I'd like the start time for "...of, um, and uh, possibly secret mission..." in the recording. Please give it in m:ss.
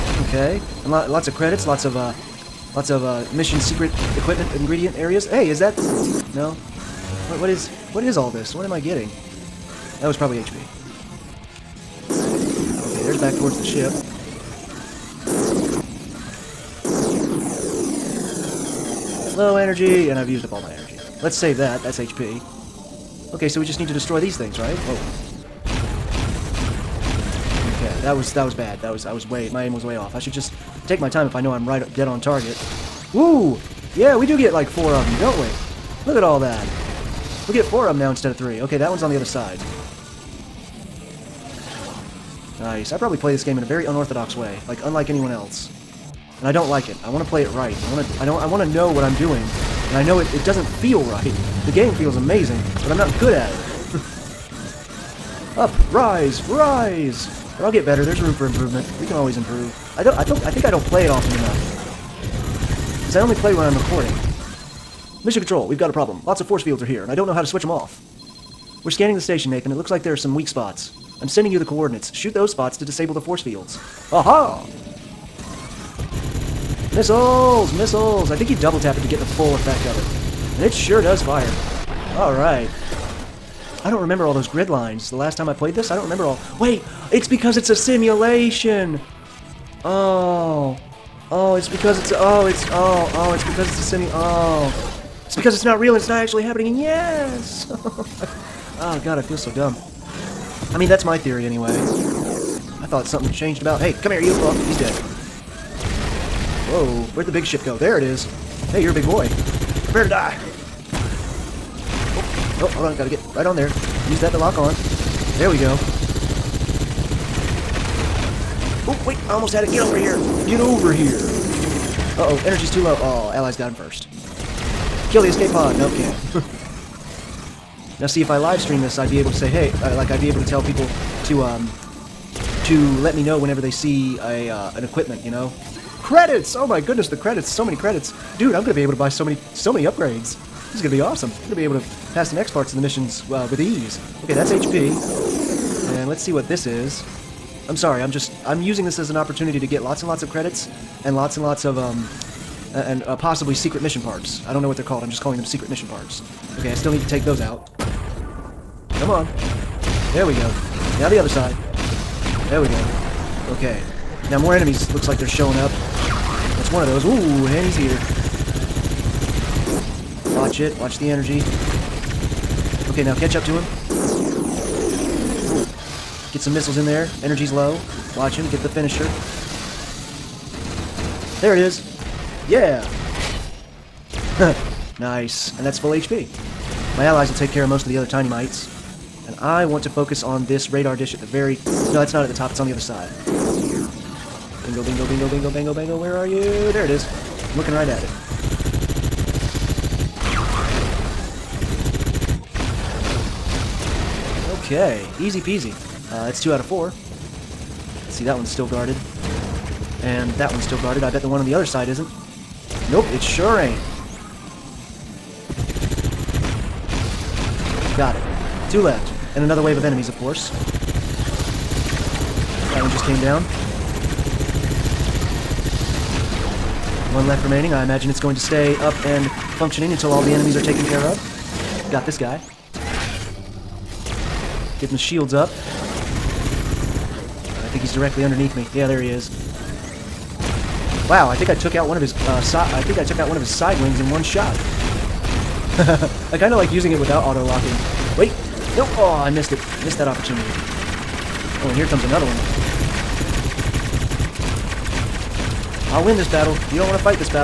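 2:31.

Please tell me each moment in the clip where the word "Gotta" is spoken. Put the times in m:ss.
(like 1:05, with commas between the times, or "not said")
1:52.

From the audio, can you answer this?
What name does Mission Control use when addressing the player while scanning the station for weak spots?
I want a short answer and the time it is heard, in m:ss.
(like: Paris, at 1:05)
Nathan, at 1:09.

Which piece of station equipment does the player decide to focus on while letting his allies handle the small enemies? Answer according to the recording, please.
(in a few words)
radar dish.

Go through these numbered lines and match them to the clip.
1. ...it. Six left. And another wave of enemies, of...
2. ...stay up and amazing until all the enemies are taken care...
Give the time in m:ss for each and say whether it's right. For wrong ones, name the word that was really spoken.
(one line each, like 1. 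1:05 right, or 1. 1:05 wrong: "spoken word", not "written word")
1. 3:38 wrong: "Two", not "Six"
2. 3:48 wrong: "functioning", not "amazing".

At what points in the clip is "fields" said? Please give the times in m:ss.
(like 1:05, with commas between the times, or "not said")
1:06, 1:13.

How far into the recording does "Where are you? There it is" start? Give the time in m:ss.
3:15.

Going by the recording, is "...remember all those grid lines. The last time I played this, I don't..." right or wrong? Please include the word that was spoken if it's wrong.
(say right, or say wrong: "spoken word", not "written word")
right.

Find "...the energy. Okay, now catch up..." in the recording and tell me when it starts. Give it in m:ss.
2:50.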